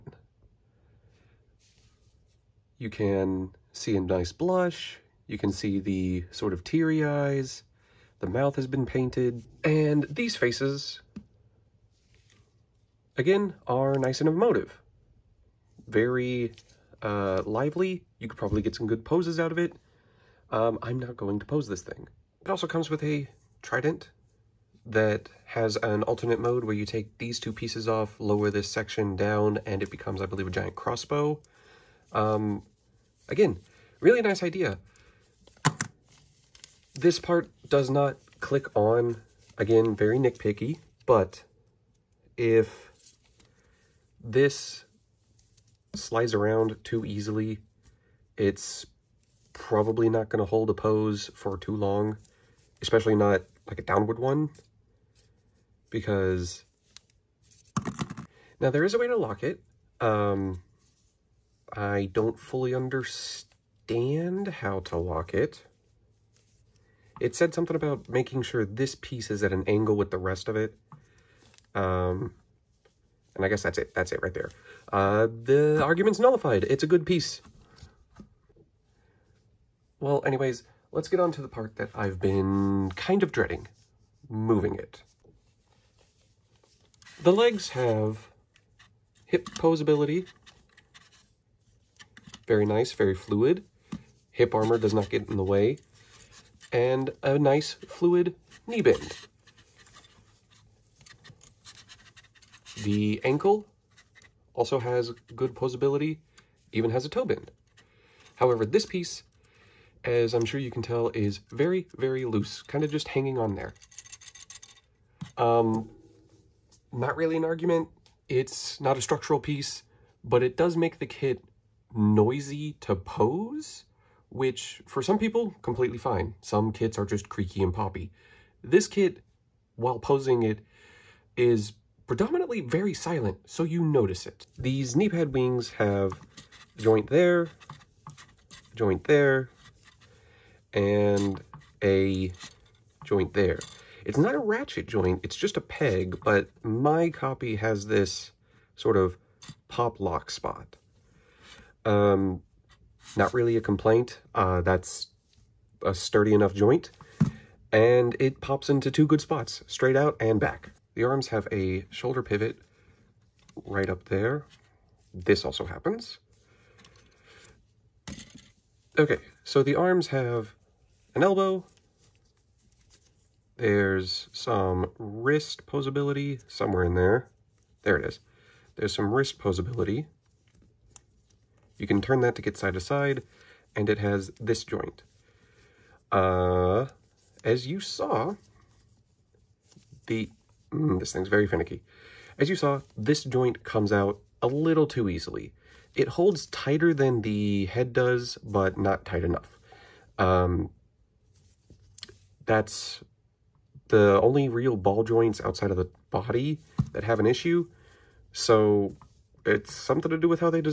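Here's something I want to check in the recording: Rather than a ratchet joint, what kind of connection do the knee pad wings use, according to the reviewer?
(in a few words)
peg.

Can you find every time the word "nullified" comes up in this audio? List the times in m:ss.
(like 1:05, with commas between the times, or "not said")
1:16.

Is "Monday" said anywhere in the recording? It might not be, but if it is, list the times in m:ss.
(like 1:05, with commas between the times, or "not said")
not said.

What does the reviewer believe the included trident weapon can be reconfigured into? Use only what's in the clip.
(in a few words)
giant crossbow.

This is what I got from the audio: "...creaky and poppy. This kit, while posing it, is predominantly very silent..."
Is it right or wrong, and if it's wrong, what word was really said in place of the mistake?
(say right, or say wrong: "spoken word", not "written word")
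right.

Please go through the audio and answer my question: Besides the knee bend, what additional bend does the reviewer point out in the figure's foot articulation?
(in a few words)
toe bend.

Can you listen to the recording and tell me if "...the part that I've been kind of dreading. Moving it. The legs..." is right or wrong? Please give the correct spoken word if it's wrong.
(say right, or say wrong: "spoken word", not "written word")
right.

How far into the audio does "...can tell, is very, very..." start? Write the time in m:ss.
1:50.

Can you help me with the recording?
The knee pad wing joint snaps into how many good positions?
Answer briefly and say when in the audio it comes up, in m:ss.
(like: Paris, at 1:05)
2, at 2:38.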